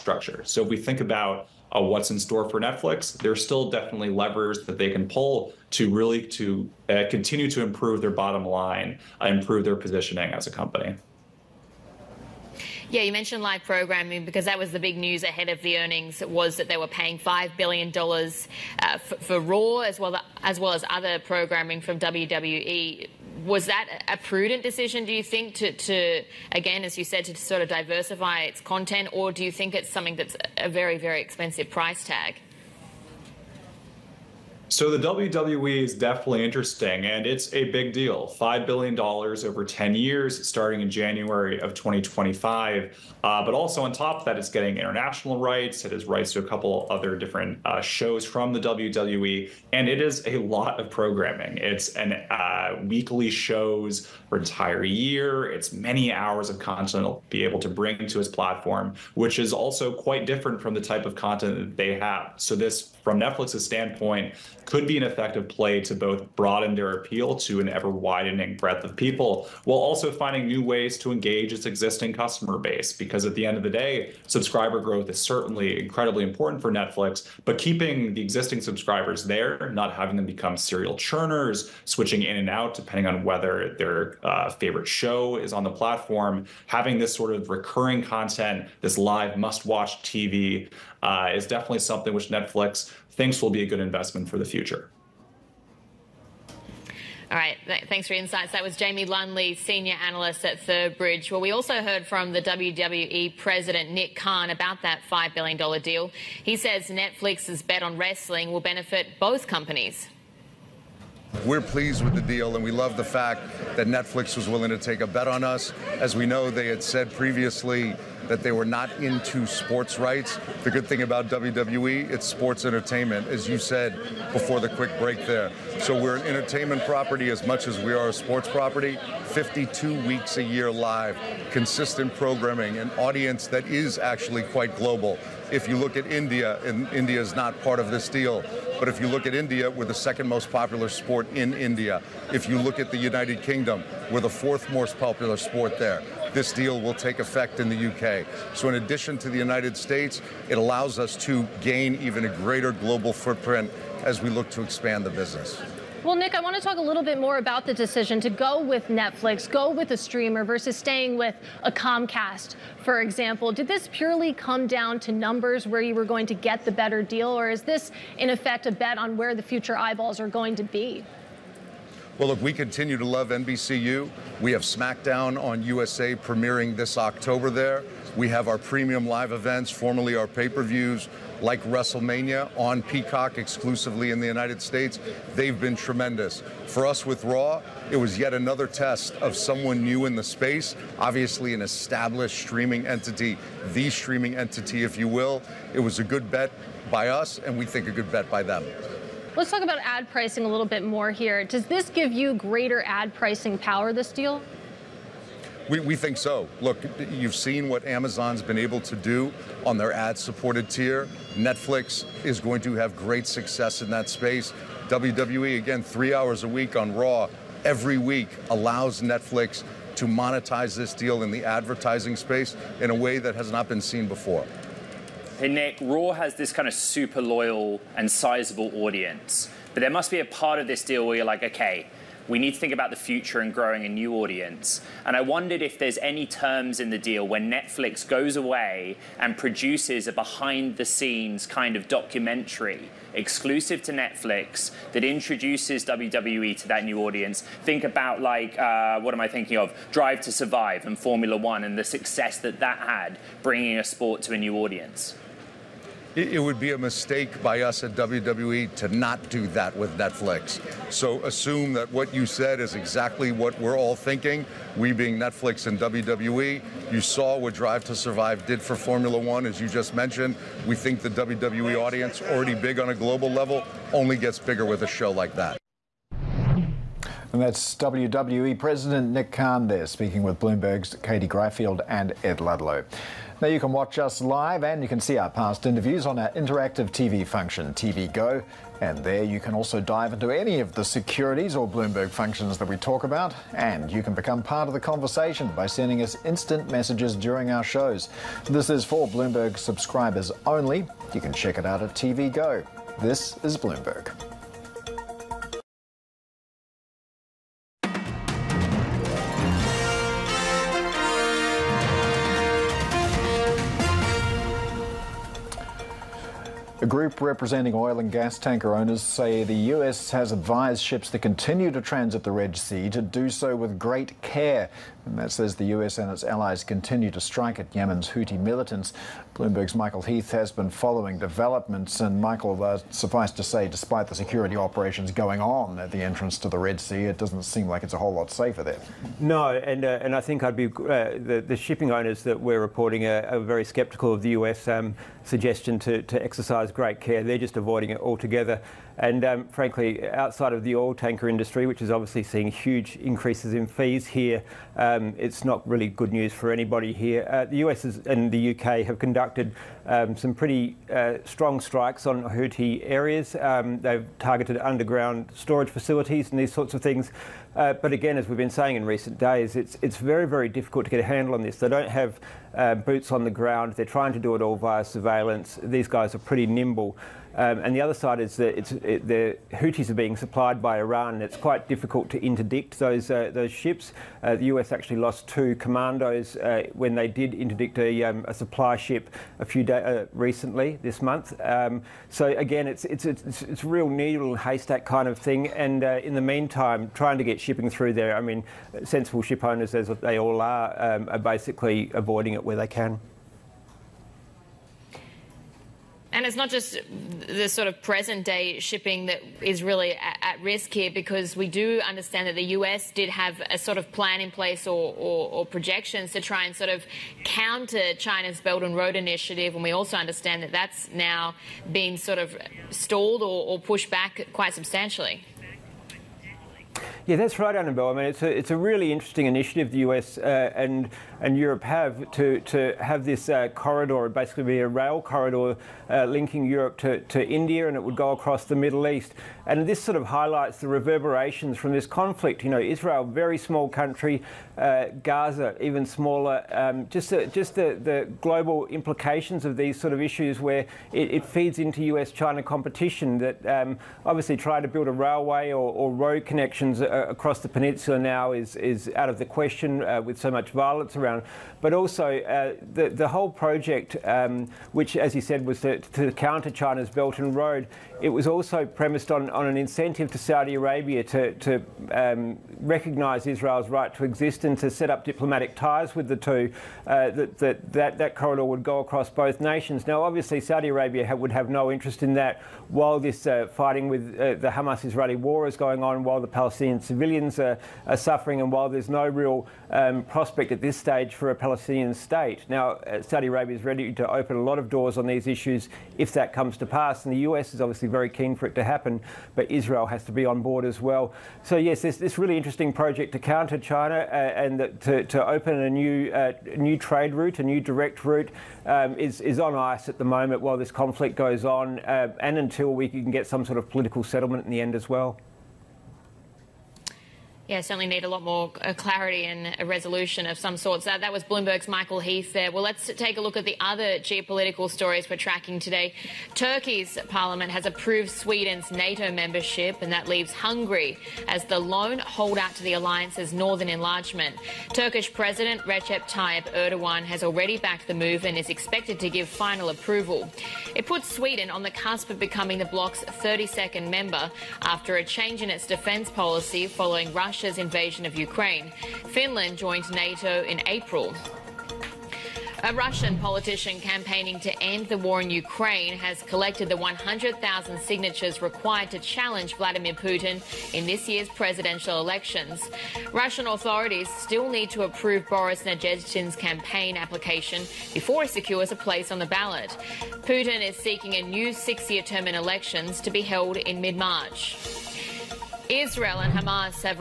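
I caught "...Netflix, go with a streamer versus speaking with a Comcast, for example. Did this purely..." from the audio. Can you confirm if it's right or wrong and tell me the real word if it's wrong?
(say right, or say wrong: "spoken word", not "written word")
wrong: "staying", not "speaking".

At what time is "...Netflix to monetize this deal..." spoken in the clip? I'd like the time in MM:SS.
03:39.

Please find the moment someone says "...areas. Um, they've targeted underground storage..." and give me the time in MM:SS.
06:02.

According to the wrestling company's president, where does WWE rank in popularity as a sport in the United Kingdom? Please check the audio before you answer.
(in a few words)
Fourth.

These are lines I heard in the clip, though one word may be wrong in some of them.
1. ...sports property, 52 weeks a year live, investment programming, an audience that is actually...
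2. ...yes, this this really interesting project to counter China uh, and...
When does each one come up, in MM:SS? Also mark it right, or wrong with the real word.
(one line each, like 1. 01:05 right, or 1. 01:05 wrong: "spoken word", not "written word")
1. 02:08 wrong: "consistent", not "investment"
2. 08:21 right.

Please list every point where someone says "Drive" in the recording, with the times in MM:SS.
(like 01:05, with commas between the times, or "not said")
04:09, 04:27.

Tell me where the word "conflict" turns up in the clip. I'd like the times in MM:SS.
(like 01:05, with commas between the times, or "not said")
07:21, 08:30.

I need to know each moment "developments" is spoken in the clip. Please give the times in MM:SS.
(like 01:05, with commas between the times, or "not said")
05:31.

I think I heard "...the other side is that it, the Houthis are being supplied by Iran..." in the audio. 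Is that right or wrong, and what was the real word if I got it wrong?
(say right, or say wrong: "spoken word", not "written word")
right.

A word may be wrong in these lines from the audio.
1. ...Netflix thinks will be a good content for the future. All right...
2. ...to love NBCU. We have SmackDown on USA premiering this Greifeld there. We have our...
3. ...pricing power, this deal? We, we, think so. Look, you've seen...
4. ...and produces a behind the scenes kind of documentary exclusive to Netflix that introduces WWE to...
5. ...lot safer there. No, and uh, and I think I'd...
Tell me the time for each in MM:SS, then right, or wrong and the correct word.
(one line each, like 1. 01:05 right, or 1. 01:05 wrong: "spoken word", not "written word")
1. 01:32 wrong: "investment", not "content"
2. 02:52 wrong: "October", not "Greifeld"
3. 03:23 right
4. 03:59 right
5. 05:38 right.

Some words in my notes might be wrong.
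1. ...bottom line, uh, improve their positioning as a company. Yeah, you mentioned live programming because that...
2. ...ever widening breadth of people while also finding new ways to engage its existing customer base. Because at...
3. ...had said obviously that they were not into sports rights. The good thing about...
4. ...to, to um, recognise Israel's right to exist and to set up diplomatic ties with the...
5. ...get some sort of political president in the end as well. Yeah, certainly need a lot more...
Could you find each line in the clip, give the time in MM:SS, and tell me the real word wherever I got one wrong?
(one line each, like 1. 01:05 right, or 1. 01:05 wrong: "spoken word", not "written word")
1. 00:08 right
2. 01:07 right
3. 01:56 wrong: "previously", not "obviously"
4. 07:51 right
5. 08:33 wrong: "settlement", not "president".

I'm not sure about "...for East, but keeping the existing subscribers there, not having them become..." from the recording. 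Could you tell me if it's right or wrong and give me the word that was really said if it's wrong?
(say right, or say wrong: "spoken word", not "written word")
wrong: "Netflix", not "East".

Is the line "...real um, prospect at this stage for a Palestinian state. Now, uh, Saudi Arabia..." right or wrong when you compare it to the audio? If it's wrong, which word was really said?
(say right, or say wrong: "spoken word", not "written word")
right.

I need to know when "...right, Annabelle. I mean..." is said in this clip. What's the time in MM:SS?
07:07.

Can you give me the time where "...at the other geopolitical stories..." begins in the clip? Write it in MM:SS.
08:43.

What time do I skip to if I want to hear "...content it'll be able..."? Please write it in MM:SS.
00:56.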